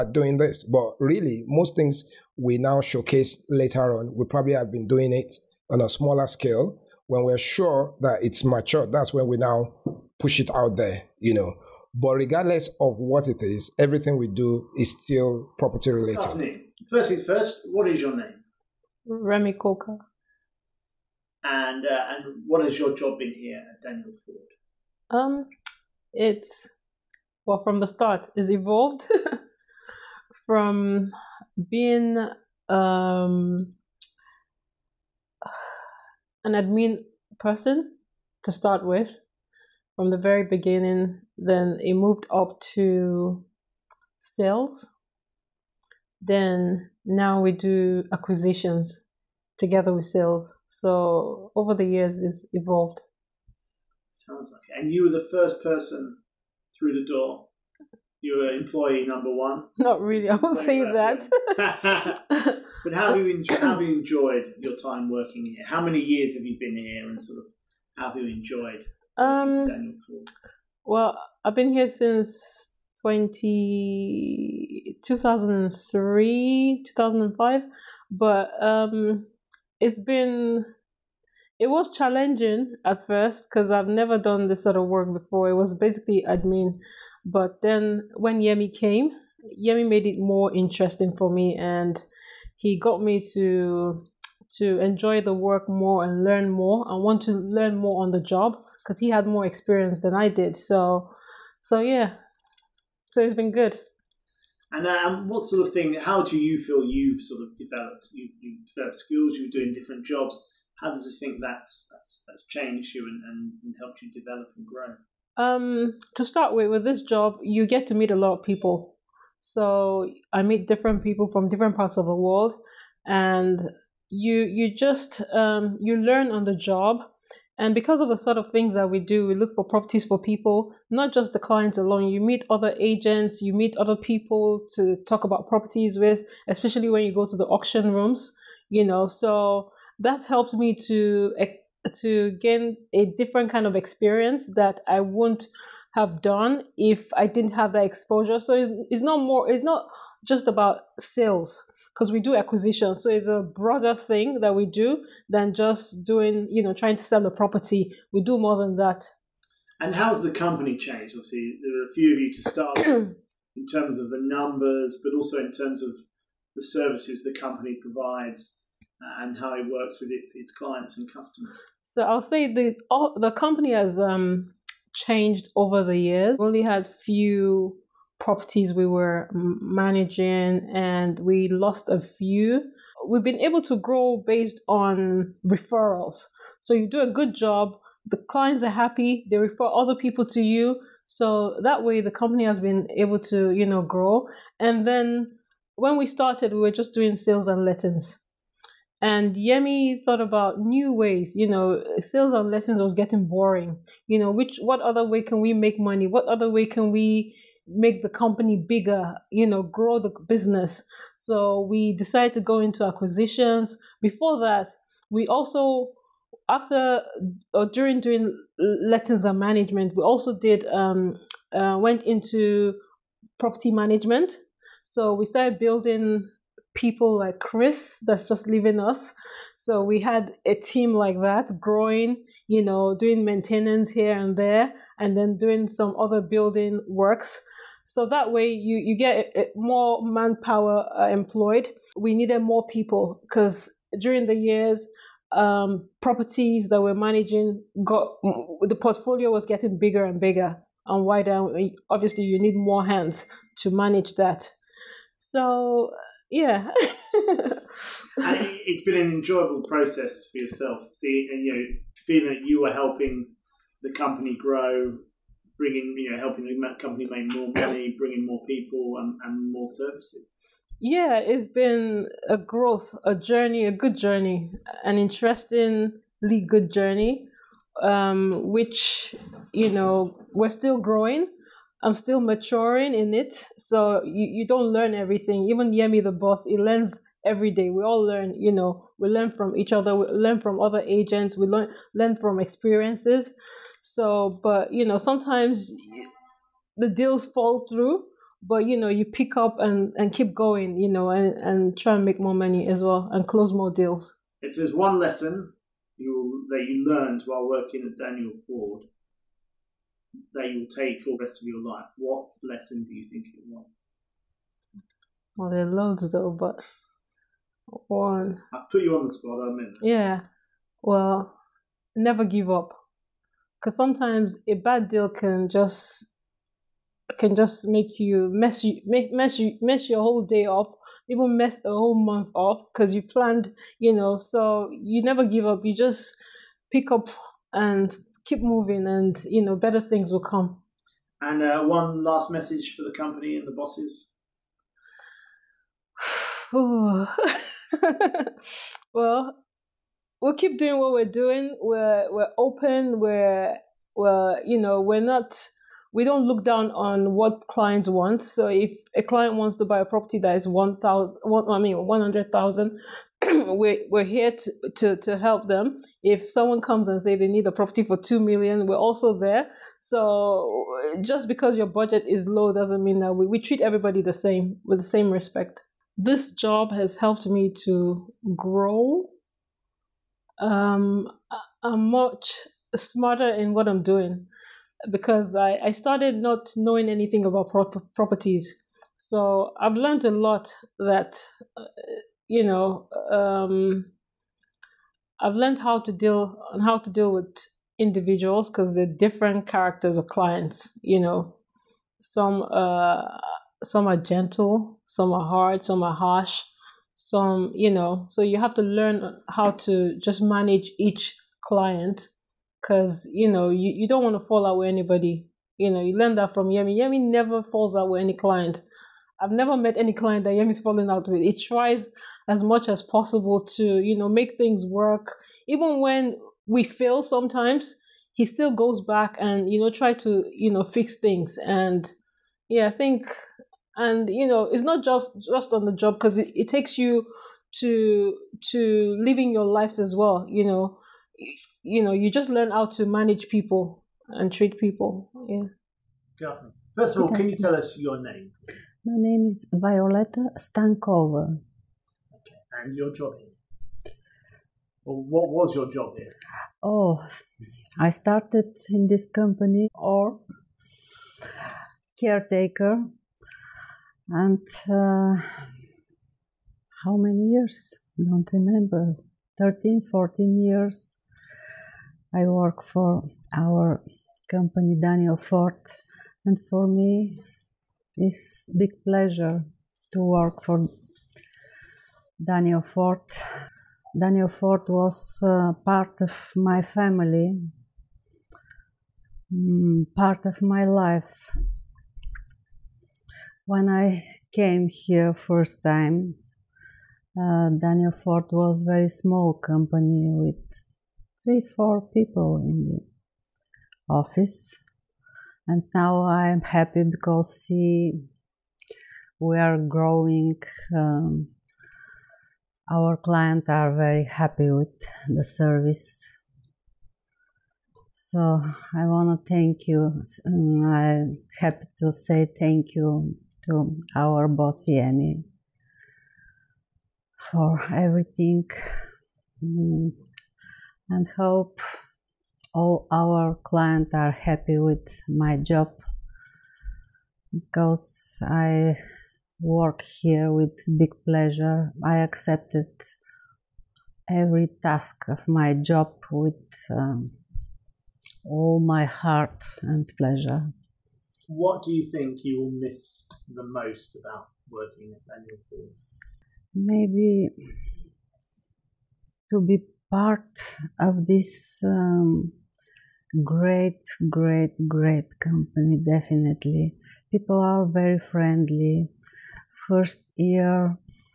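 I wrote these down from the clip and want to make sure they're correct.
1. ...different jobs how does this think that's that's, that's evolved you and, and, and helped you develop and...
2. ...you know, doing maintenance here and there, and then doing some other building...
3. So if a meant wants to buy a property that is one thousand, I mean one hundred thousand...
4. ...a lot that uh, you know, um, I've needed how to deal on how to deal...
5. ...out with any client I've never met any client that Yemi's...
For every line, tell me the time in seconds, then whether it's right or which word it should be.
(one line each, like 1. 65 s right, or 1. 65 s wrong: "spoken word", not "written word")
1. 109 s wrong: "changed", not "evolved"
2. 232 s right
3. 358 s wrong: "client", not "meant"
4. 390 s wrong: "learned", not "needed"
5. 417 s right.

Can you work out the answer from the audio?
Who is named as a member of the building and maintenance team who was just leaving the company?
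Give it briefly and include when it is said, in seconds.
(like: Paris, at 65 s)
Chris, at 227 s.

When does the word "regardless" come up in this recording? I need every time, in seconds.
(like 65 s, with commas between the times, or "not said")
12 s.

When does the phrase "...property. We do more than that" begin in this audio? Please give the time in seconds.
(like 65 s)
157 s.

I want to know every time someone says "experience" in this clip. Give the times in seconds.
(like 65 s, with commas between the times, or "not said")
99 s, 143 s, 292 s.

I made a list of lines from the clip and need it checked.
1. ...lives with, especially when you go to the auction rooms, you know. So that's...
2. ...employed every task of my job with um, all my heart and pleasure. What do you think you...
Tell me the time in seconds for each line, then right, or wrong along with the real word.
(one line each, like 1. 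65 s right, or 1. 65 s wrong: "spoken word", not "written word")
1. 135 s wrong: "properties", not "lives"
2. 541 s wrong: "accepted", not "employed".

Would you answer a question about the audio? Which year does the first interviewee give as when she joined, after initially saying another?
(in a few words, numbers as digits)
2005.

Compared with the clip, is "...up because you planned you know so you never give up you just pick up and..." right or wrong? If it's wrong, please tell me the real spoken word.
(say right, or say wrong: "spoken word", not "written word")
right.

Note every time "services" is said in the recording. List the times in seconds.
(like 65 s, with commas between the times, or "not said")
166 s, 269 s, 515 s.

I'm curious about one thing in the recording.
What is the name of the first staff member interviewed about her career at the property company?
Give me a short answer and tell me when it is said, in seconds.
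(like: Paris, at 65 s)
Remy Coca, at 19 s.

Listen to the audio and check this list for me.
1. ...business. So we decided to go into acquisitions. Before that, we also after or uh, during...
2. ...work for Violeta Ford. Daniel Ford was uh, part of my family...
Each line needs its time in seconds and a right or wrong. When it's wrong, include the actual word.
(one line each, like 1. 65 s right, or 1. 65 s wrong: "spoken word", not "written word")
1. 210 s right
2. 480 s wrong: "Daniel", not "Violeta".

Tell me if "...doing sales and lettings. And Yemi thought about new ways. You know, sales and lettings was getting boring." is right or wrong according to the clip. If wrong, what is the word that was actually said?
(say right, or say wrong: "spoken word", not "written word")
right.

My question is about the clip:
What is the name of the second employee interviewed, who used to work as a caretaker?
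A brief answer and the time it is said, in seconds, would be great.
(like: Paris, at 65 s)
Violeta Stankova, at 449 s.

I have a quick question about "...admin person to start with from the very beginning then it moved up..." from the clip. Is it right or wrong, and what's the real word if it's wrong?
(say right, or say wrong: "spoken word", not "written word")
right.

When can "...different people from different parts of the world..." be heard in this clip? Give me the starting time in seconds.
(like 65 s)
120 s.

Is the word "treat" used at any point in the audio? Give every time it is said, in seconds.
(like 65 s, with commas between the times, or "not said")
373 s, 444 s.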